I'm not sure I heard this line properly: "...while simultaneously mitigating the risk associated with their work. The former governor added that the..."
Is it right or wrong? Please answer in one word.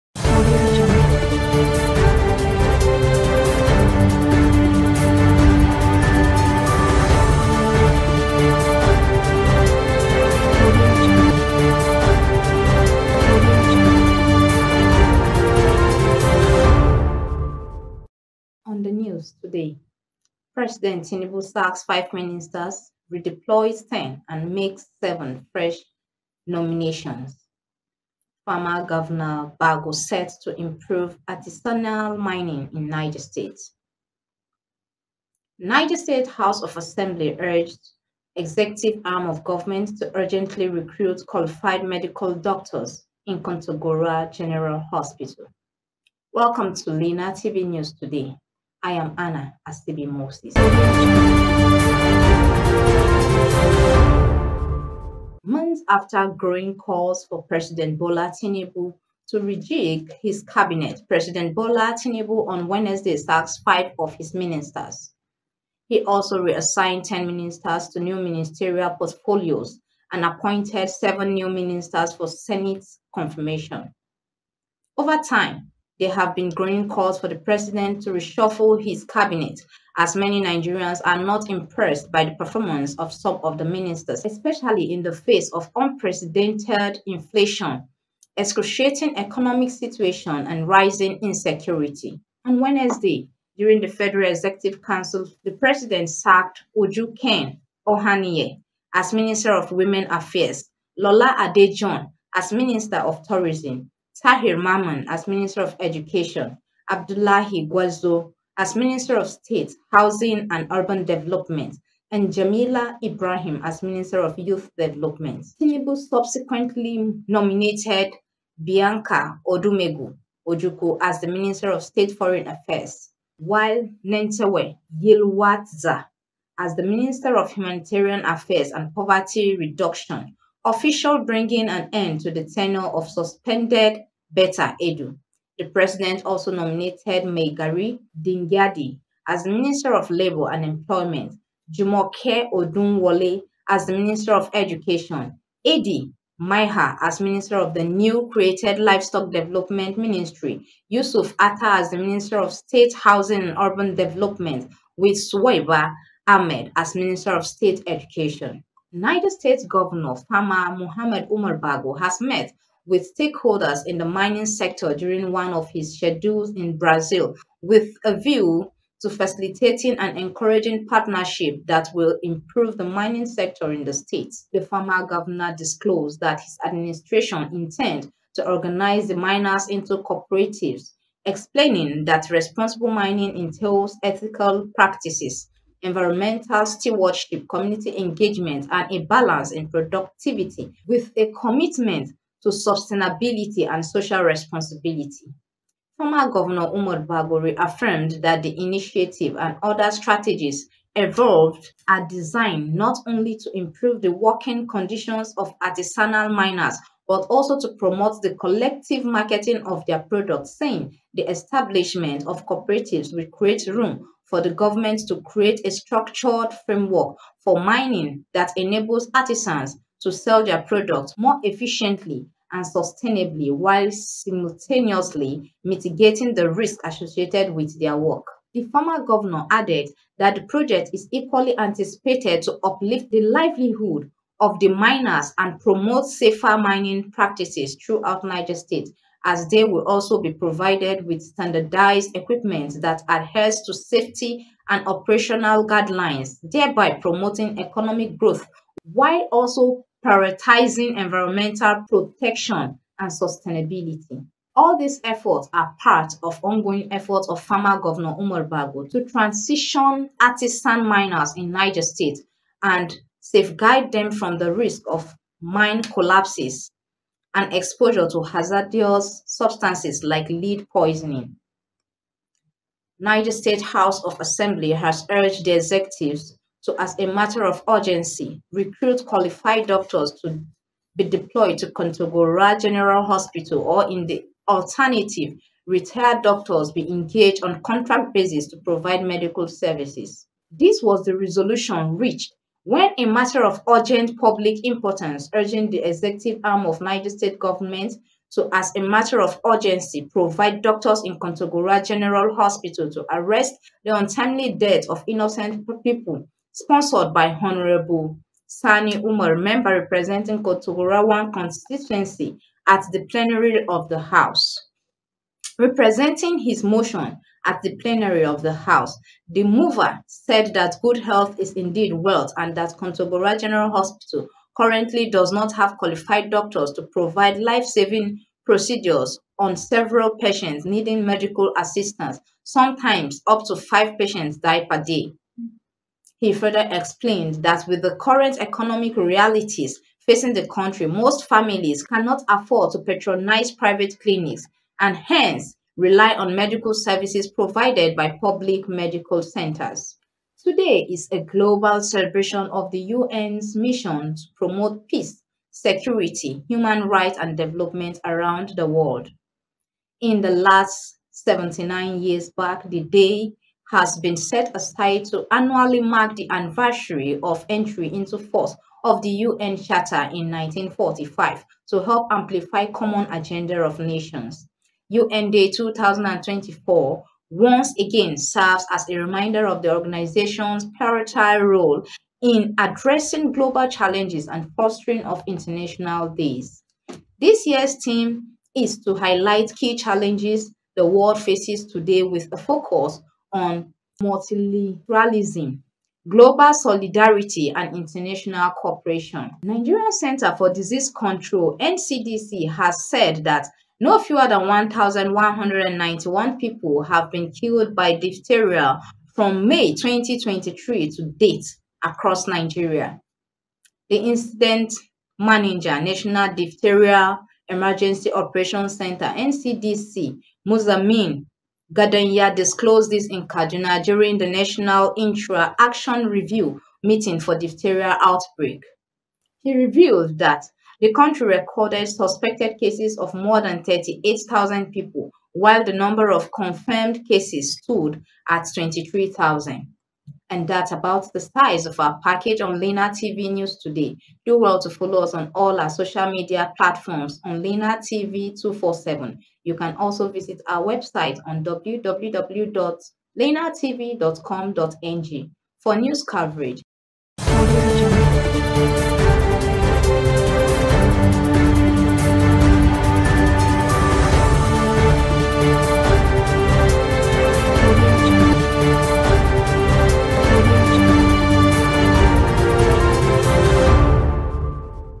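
right.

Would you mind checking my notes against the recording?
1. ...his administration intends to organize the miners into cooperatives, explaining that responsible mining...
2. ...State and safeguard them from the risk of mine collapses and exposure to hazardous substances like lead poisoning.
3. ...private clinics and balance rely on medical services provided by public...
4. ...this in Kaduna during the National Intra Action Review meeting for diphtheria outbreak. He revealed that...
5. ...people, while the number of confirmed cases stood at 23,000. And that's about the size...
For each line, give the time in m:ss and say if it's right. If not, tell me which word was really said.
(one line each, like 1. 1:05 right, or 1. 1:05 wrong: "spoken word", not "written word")
1. 2:56 right
2. 4:21 right
3. 5:43 wrong: "hence", not "balance"
4. 7:02 right
5. 7:14 right.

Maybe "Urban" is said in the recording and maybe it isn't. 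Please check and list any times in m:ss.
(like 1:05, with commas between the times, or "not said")
1:50, 2:33.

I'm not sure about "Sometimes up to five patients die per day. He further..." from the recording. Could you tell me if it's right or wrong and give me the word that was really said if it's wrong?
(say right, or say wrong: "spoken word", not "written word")
right.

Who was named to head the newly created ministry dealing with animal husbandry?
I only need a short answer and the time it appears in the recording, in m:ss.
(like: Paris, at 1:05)
Idi Maiha, at 2:25.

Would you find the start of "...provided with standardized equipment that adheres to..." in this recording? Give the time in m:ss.
4:00.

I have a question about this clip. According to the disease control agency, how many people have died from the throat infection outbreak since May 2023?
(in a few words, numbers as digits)
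1,191.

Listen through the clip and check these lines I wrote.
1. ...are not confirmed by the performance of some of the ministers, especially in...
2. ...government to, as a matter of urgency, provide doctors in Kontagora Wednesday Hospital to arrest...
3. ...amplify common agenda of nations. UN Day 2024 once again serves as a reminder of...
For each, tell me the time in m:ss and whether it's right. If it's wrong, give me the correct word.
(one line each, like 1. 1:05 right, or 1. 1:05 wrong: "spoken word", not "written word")
1. 1:21 wrong: "impressed", not "confirmed"
2. 4:57 wrong: "General", not "Wednesday"
3. 6:12 right.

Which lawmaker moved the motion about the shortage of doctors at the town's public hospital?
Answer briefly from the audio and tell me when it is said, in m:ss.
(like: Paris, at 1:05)
Sani Umar, at 5:08.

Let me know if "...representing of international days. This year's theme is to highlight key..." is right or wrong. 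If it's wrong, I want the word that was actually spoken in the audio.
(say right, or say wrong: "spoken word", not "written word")
wrong: "fostering", not "representing".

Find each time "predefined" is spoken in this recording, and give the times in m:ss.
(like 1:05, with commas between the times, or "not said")
not said.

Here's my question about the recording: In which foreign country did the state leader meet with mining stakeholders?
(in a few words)
Brazil.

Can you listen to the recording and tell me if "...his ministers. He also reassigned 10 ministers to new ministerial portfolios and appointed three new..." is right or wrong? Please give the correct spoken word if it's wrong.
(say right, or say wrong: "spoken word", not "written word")
wrong: "seven", not "three".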